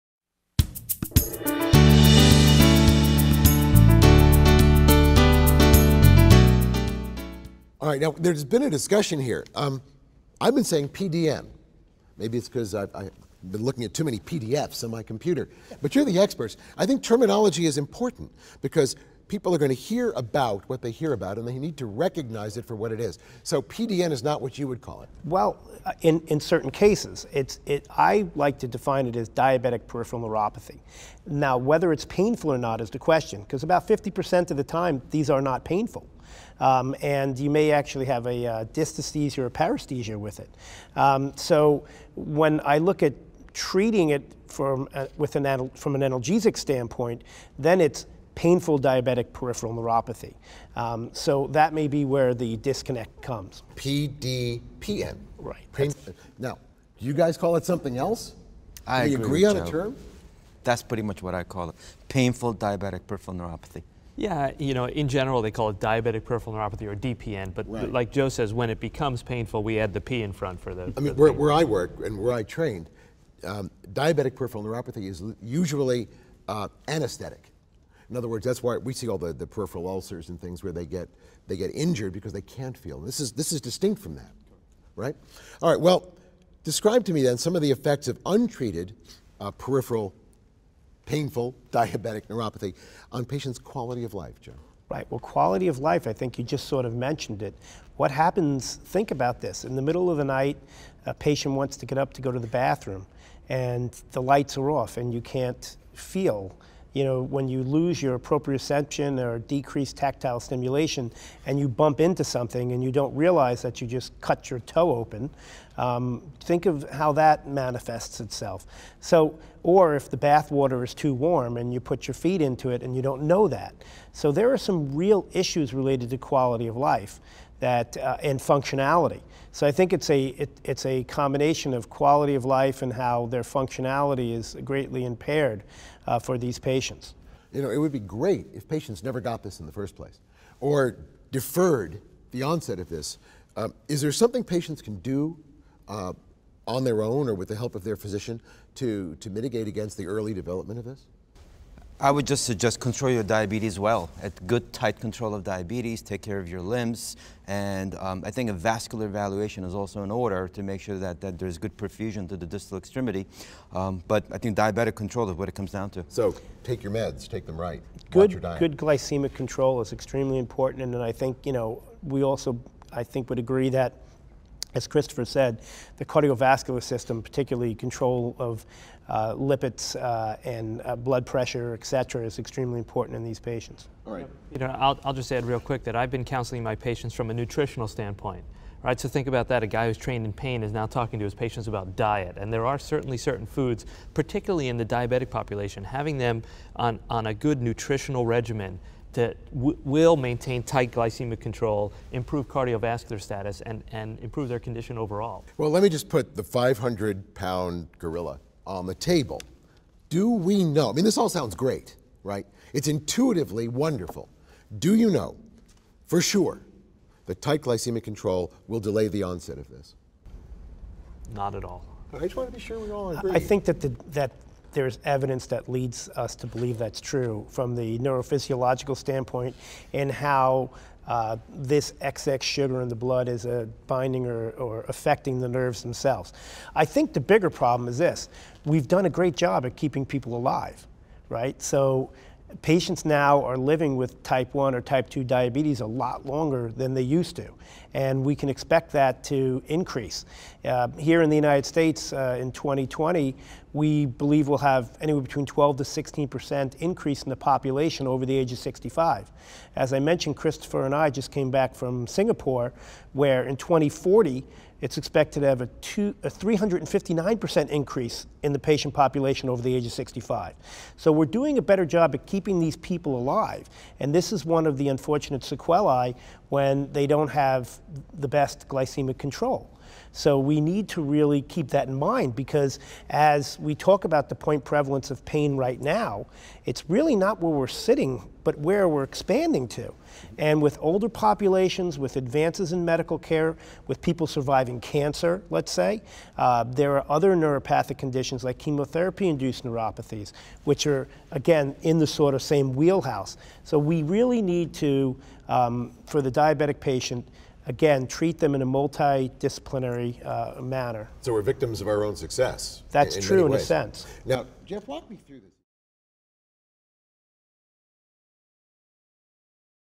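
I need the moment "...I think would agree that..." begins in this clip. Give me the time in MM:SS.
02:52.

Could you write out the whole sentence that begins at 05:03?
So we really need to, um, for the diabetic patient, again, treat them in a multidisciplinary uh, manner.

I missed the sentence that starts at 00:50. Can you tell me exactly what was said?
Um, so that may be where the disconnect comes.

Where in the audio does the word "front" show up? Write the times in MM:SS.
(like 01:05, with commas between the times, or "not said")
01:10.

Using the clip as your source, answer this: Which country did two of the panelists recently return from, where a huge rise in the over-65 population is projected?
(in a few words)
Singapore.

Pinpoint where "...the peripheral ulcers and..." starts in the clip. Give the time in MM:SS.
01:19.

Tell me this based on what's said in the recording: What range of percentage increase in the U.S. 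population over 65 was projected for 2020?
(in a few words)
12 to 16 percent.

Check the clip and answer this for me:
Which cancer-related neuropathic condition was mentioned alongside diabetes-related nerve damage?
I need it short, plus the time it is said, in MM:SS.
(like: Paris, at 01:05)
chemotherapy induced neuropathies, at 04:58.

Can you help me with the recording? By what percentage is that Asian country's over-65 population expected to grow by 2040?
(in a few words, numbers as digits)
359%.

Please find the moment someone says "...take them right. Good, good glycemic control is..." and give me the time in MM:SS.
02:47.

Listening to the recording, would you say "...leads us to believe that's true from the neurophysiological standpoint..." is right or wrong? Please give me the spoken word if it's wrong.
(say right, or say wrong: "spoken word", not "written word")
right.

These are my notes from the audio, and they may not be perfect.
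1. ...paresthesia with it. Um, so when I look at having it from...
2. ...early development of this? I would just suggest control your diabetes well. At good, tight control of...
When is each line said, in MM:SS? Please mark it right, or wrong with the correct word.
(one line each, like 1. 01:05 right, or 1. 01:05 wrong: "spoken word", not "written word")
1. 00:39 wrong: "treating", not "having"
2. 02:30 right.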